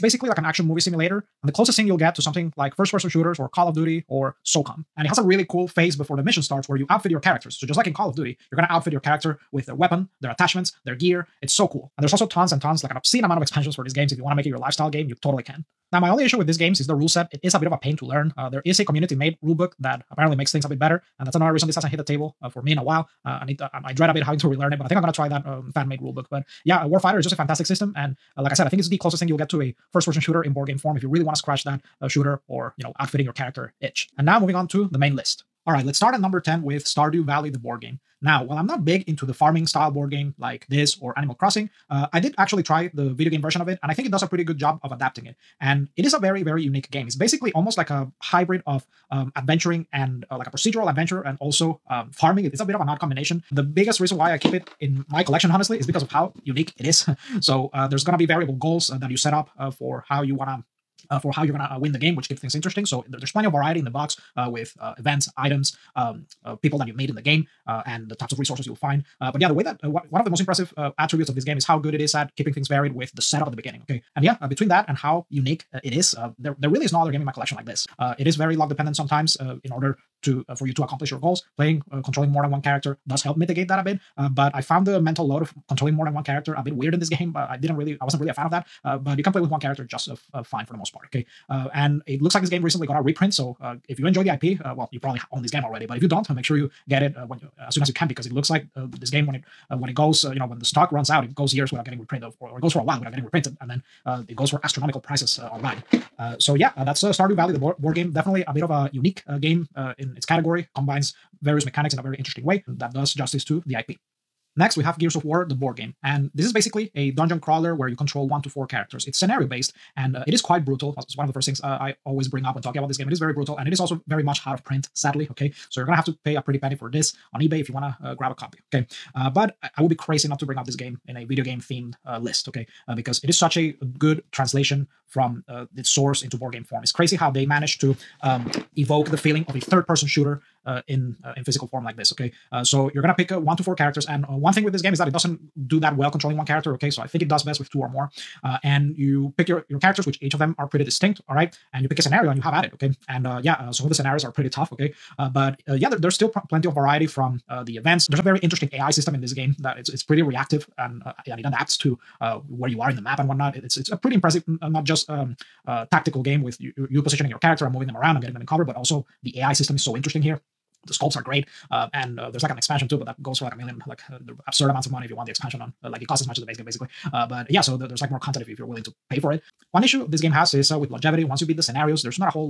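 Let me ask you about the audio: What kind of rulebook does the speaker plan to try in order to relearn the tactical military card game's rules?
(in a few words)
fan made rulebook.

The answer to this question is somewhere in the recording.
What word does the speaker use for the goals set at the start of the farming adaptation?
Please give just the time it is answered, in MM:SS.
00:58.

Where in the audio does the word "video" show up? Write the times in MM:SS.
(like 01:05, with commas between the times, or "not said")
00:43, 02:11.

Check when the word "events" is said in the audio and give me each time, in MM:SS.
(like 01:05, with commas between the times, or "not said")
01:04, 02:37.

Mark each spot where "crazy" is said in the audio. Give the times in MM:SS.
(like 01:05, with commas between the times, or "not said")
02:09, 02:16.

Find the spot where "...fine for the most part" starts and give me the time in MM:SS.
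01:30.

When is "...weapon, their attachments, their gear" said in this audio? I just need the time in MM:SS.
00:09.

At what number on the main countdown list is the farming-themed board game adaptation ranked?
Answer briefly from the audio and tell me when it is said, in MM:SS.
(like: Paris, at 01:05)
10, at 00:36.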